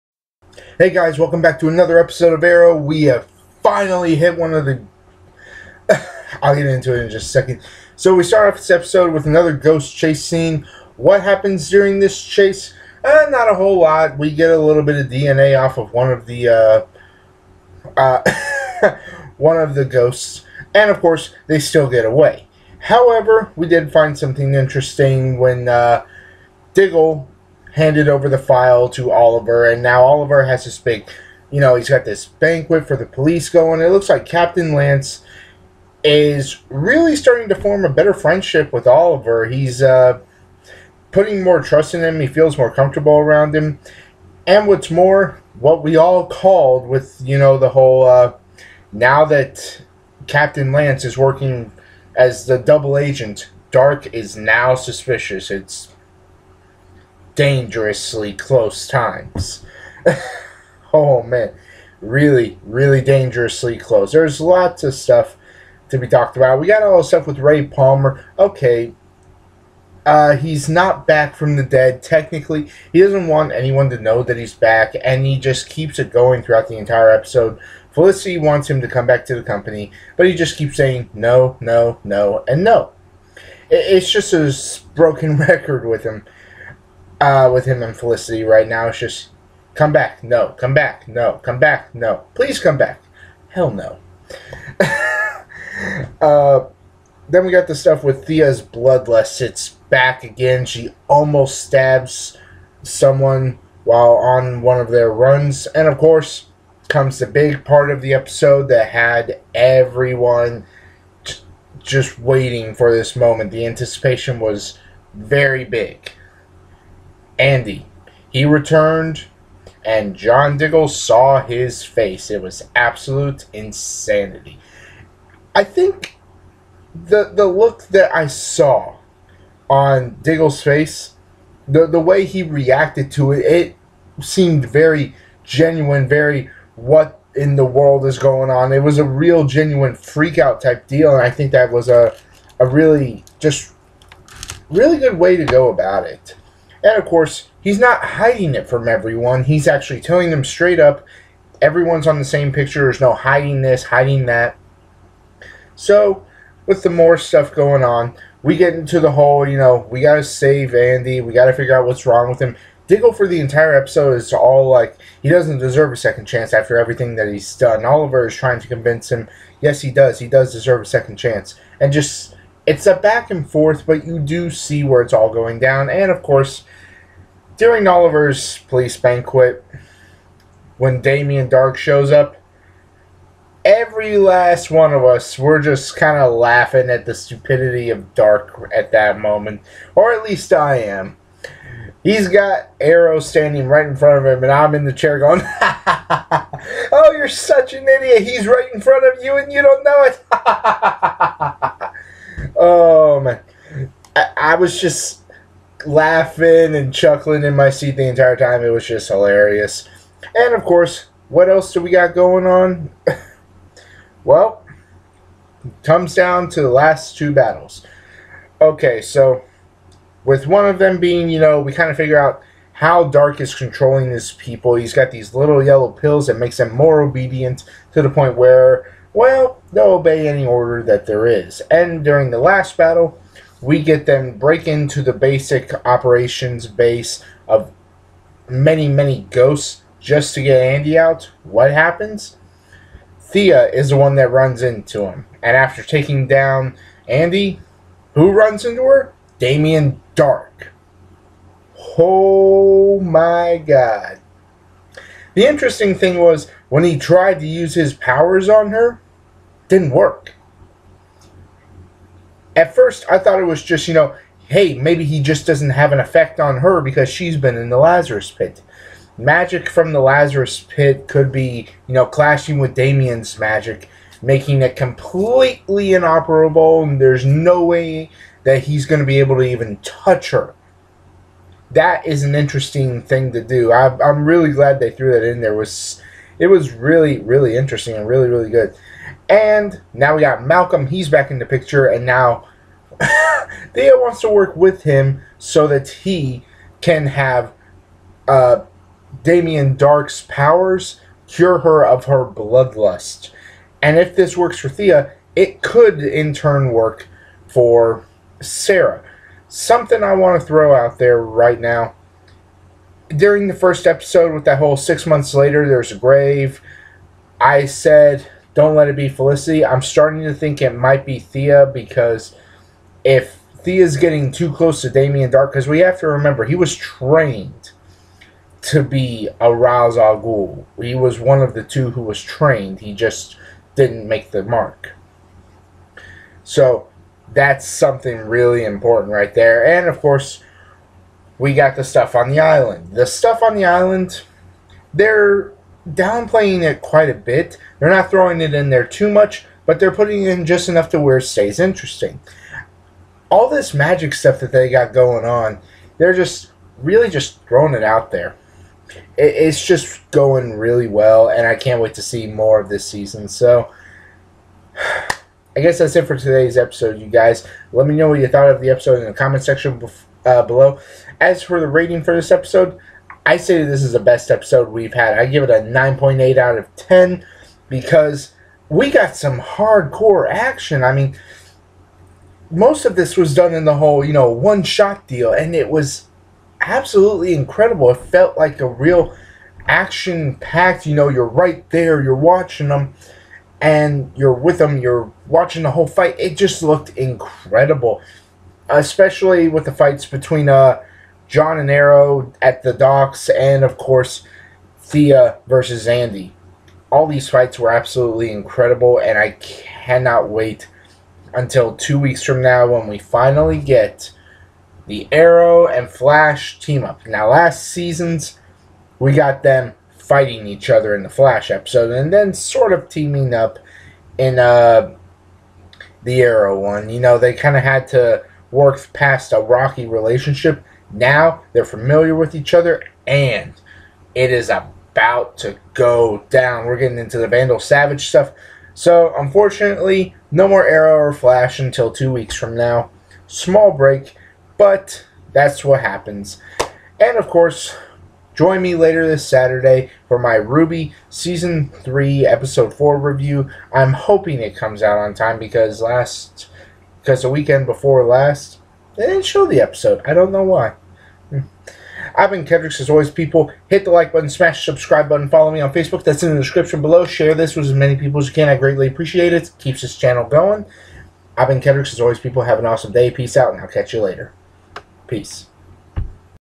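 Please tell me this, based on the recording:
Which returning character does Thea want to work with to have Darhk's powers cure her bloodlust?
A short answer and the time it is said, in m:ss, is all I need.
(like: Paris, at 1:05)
Malcolm, at 4:50.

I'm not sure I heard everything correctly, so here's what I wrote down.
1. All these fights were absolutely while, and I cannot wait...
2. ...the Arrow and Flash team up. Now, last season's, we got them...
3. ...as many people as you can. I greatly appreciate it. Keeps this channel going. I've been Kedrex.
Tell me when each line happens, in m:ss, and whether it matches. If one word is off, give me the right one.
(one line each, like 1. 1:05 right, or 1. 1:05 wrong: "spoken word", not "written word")
1. 6:46 wrong: "incredible", not "while"
2. 6:54 right
3. 7:47 right.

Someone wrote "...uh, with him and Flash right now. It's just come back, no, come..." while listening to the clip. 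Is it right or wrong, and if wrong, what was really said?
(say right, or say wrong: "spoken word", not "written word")
wrong: "Felicity", not "Flash".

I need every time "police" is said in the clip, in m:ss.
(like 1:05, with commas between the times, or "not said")
0:33, 2:58.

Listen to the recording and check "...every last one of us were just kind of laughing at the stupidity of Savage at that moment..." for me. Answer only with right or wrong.
wrong.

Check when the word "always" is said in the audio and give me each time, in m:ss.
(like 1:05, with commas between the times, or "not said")
7:42, 7:52.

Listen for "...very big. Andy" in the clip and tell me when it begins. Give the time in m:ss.
1:55.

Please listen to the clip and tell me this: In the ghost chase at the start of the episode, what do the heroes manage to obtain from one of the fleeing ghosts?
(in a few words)
DNA.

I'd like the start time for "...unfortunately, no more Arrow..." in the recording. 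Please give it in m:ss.
7:19.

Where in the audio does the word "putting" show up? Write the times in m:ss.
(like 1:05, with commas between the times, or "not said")
0:41, 5:49.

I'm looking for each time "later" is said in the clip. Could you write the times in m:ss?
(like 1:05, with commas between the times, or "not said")
5:15, 7:28, 7:54.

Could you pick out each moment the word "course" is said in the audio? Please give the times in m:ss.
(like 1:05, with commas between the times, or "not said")
0:21, 1:45, 2:27, 2:56, 3:30, 5:40, 6:43, 7:27.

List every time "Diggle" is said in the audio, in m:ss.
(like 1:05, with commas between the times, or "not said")
0:26, 2:00, 2:10, 2:42.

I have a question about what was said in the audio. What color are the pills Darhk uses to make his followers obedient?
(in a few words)
Yellow.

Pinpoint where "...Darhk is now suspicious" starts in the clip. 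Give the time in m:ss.
0:53.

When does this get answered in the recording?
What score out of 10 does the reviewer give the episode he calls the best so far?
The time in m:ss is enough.
6:15.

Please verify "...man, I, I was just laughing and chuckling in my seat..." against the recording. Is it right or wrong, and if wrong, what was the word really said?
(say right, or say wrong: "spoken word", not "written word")
right.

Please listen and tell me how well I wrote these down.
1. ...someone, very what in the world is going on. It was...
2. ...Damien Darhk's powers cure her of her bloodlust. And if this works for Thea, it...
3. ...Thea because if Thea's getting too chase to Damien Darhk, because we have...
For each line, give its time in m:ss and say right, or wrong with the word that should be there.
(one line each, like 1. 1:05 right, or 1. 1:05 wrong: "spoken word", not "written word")
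1. 2:15 wrong: "genuine", not "someone"
2. 4:59 right
3. 5:21 wrong: "close", not "chase".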